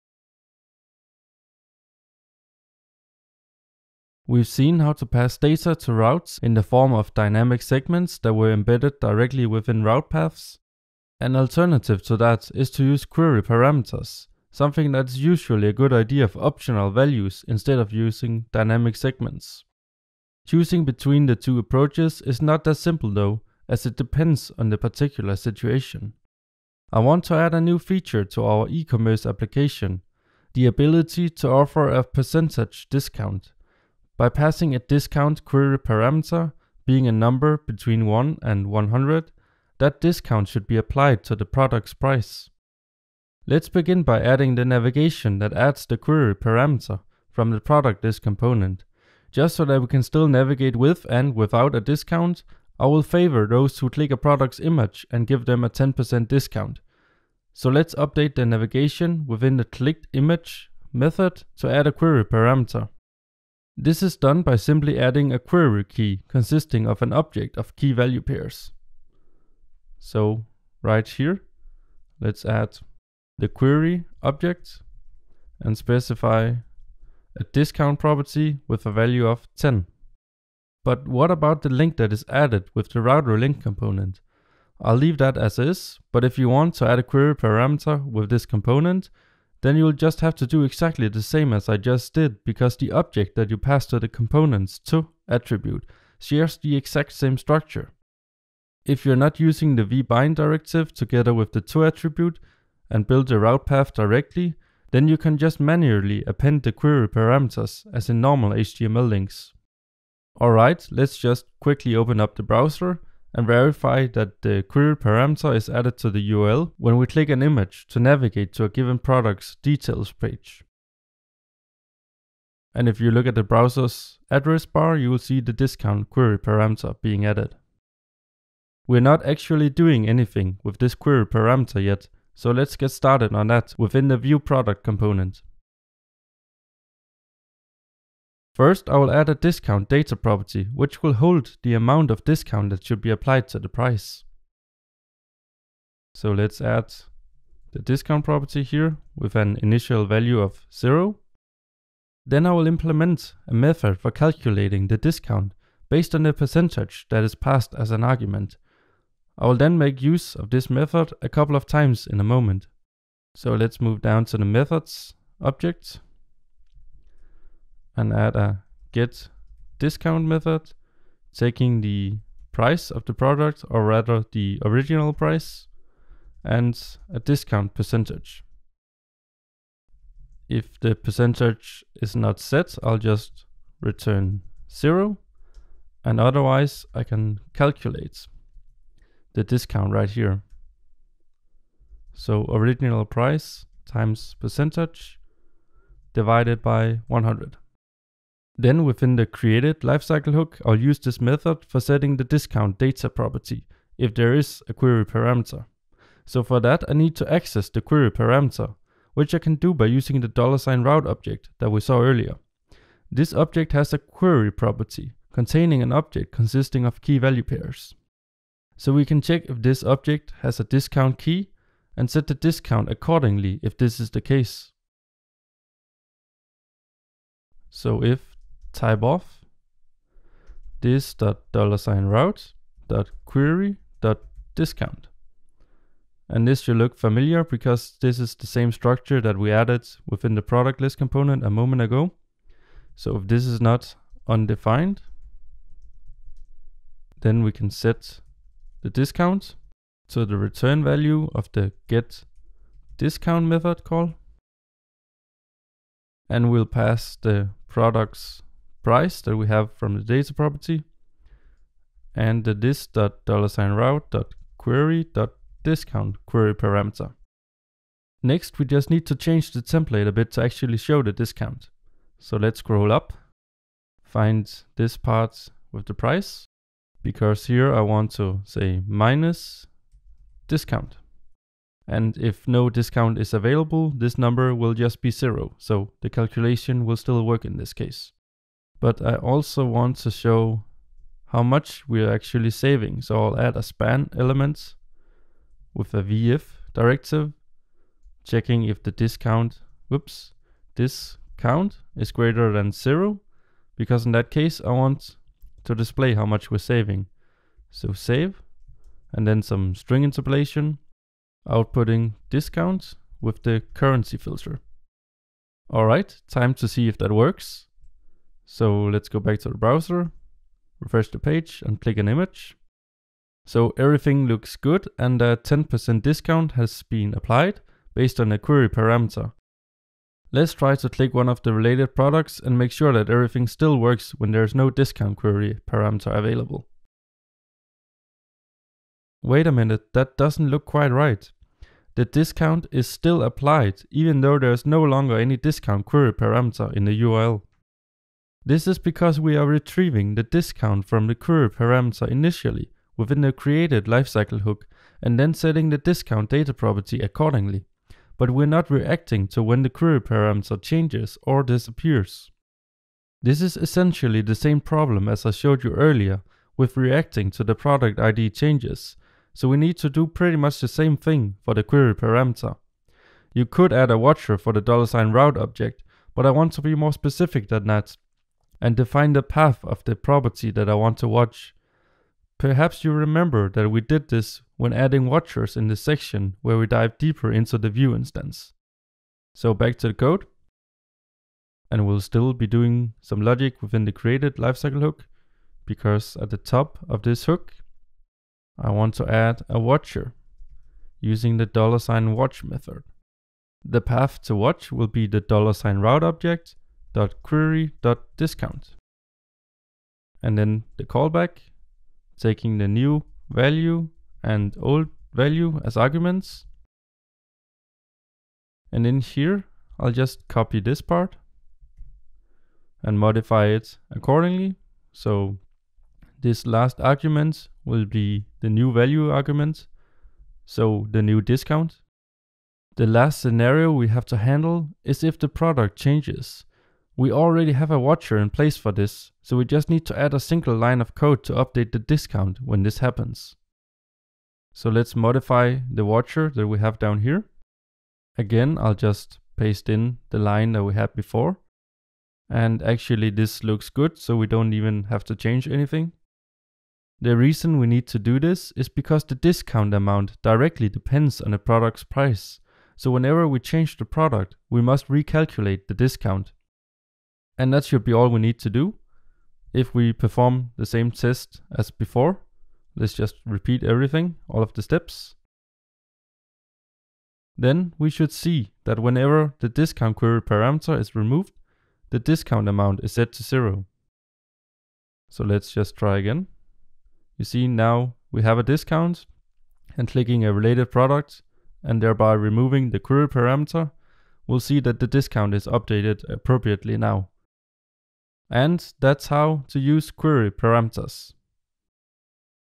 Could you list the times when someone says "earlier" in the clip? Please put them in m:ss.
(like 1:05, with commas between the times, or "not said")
3:32, 6:05.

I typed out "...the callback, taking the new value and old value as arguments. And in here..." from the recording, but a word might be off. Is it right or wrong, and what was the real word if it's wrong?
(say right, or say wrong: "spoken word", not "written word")
right.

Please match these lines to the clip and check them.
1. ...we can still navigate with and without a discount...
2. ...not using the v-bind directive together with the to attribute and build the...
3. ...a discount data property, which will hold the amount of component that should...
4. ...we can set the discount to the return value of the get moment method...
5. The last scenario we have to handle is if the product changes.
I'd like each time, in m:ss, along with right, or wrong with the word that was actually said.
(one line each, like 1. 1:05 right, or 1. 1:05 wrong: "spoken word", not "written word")
1. 0:49 right
2. 1:39 right
3. 2:19 wrong: "discount", not "component"
4. 4:07 wrong: "discount", not "moment"
5. 7:12 right.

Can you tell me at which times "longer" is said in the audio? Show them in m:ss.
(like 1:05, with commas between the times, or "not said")
5:44.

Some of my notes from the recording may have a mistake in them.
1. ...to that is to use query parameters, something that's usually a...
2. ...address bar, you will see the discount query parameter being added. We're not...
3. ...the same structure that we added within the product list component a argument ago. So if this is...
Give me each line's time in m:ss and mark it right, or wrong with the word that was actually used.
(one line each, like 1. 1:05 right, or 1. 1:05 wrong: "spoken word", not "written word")
1. 0:12 right
2. 2:04 right
3. 3:58 wrong: "moment", not "argument".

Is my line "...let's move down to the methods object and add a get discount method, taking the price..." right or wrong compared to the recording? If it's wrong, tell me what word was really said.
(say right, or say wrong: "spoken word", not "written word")
right.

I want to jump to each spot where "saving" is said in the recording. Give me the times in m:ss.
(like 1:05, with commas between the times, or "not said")
4:52, 5:06.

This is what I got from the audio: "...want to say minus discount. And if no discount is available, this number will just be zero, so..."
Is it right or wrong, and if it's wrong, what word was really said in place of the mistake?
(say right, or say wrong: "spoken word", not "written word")
right.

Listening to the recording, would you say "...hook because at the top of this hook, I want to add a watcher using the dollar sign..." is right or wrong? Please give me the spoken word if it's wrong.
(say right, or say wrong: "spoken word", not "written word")
right.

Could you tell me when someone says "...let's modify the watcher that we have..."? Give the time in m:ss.
7:24.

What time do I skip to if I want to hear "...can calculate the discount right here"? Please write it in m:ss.
3:07.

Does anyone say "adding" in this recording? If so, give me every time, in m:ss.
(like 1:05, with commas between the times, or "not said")
0:44, 1:04, 6:24.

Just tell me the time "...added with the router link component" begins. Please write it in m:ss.
1:22.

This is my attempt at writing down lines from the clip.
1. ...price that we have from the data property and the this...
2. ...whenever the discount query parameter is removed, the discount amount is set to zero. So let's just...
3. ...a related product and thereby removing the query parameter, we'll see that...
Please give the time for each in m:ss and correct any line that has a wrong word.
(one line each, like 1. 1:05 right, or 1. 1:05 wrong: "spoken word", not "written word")
1. 4:18 right
2. 7:58 right
3. 8:10 right.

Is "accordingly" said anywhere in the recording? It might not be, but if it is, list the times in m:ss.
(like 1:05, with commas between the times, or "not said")
3:42, 5:56, 7:03.